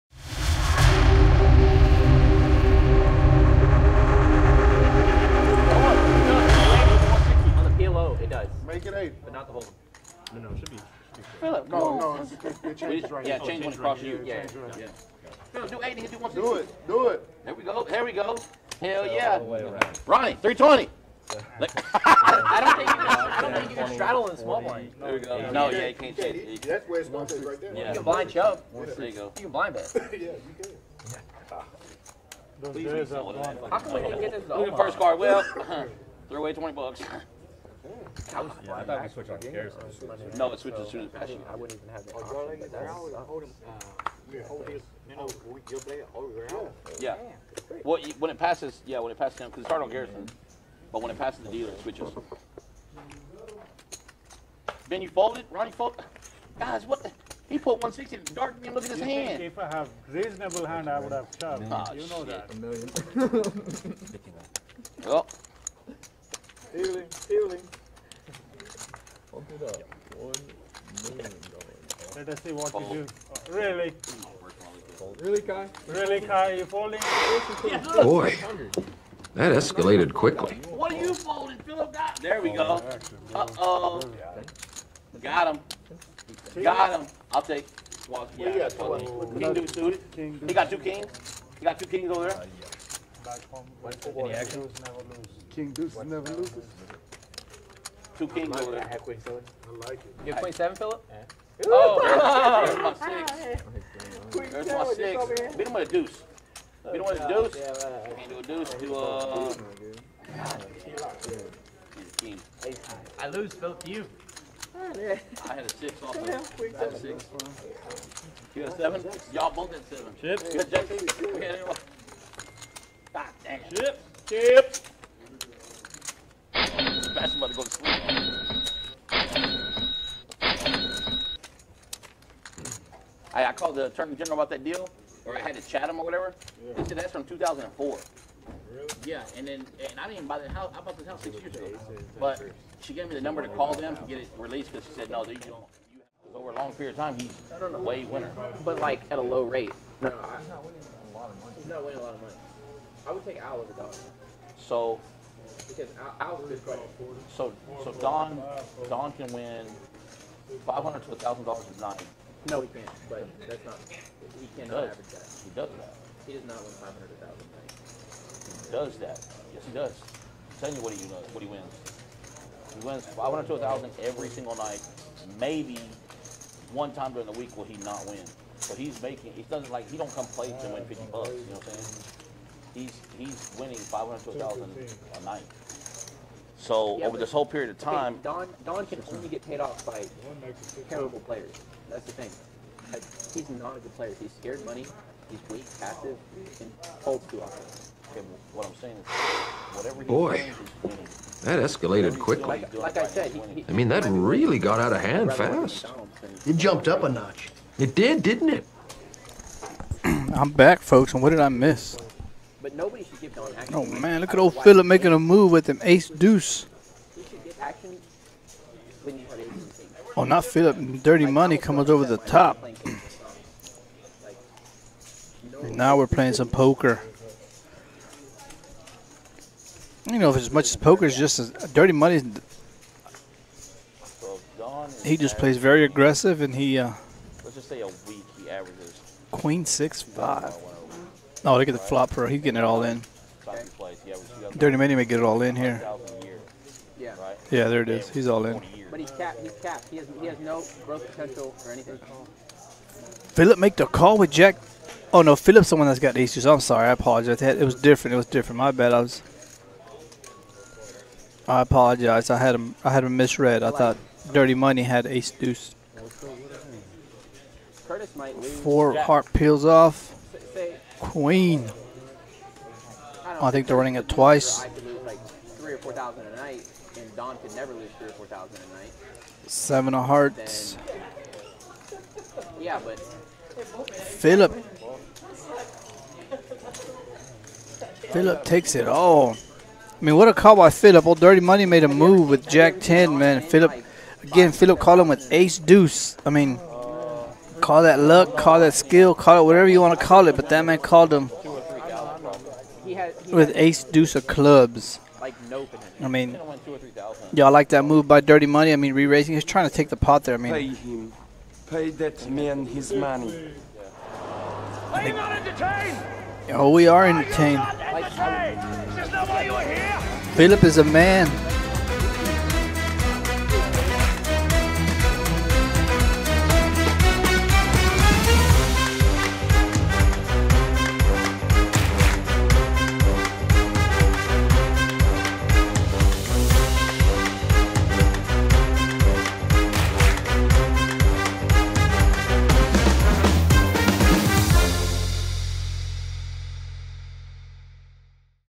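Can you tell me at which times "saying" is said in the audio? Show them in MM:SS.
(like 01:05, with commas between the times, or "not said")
03:01, 03:18.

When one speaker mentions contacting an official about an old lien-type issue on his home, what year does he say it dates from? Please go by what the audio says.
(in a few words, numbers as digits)
2004.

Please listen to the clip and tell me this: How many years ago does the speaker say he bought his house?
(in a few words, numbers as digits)
6.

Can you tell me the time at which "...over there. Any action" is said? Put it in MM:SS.
01:32.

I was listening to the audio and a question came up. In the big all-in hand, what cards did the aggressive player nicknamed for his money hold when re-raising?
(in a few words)
Jack 10.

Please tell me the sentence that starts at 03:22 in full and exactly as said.
Like, like I said, he, he, I mean that really got out of hand fast.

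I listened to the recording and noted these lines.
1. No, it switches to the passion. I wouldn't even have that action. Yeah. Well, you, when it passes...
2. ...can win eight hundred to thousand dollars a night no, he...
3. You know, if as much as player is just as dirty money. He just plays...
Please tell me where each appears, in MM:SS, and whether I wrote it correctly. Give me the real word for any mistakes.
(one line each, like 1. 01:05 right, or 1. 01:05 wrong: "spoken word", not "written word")
1. 00:40 wrong: "option", not "action"
2. 02:39 wrong: "five", not "eight"
3. 03:50 wrong: "poker", not "player".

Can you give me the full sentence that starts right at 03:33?
Oh man, look at old Philip making a move with him ace deuce.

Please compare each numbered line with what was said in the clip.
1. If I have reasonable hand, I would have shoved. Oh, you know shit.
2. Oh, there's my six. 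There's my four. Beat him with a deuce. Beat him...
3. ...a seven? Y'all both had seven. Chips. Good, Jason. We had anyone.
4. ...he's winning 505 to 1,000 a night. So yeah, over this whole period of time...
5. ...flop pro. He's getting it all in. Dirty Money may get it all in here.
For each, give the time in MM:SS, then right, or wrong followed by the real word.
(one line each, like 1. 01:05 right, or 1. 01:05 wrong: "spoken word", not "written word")
1. 00:59 right
2. 01:41 wrong: "six", not "four"
3. 01:58 right
4. 03:03 wrong: "500", not "505"
5. 04:01 right.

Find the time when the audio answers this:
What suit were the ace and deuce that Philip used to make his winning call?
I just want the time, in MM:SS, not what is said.
05:04.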